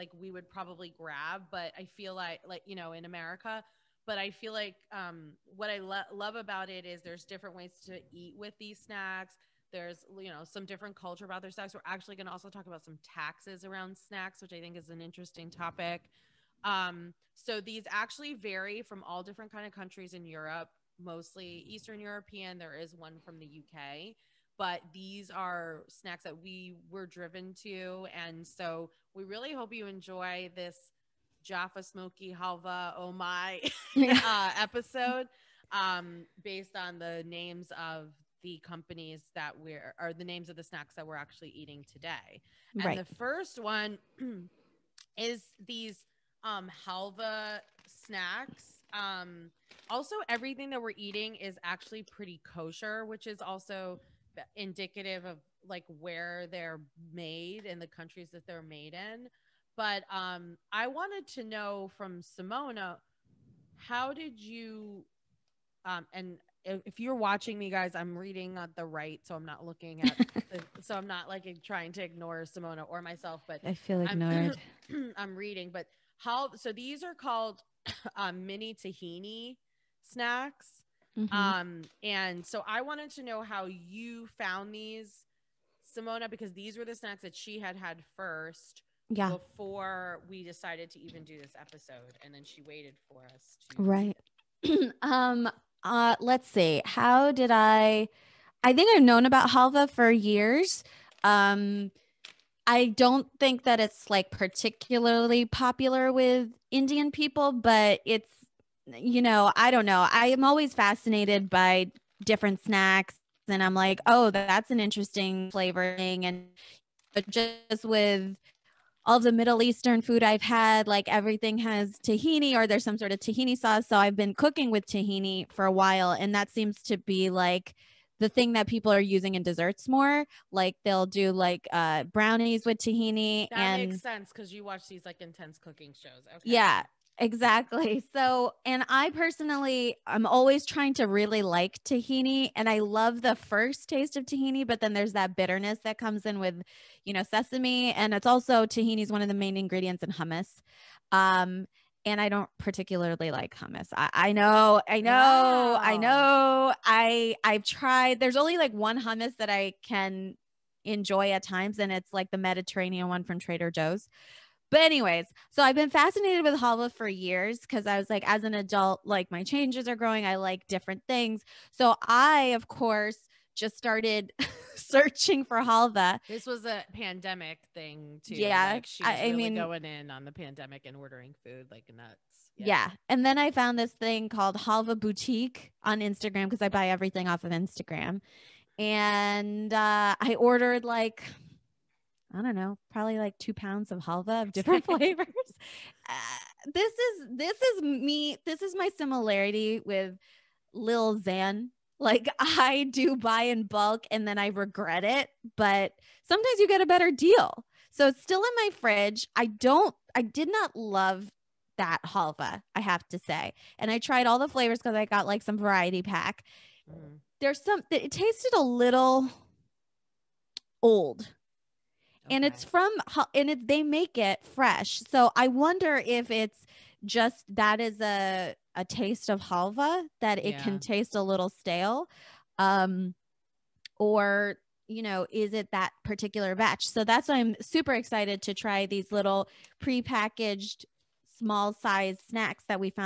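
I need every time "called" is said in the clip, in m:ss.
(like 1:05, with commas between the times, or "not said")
1:17, 3:04.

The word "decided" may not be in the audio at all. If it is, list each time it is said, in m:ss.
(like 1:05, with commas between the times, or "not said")
1:30.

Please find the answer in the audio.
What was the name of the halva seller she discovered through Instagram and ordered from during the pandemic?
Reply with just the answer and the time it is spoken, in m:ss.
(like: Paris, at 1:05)
Halva Boutique, at 3:04.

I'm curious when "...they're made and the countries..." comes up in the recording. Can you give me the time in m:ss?
0:56.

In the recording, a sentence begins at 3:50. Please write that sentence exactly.
can taste a little stale, um, or you know is it that particular batch?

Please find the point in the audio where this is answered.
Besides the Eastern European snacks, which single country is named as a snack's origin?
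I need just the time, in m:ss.
0:23.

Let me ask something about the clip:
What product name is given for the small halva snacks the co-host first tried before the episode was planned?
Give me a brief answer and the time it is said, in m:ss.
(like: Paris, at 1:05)
mini tahini snacks, at 1:18.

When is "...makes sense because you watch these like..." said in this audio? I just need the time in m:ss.
2:13.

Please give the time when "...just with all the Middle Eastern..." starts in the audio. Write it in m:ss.
1:57.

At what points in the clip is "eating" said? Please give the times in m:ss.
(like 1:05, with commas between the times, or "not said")
0:41, 0:50.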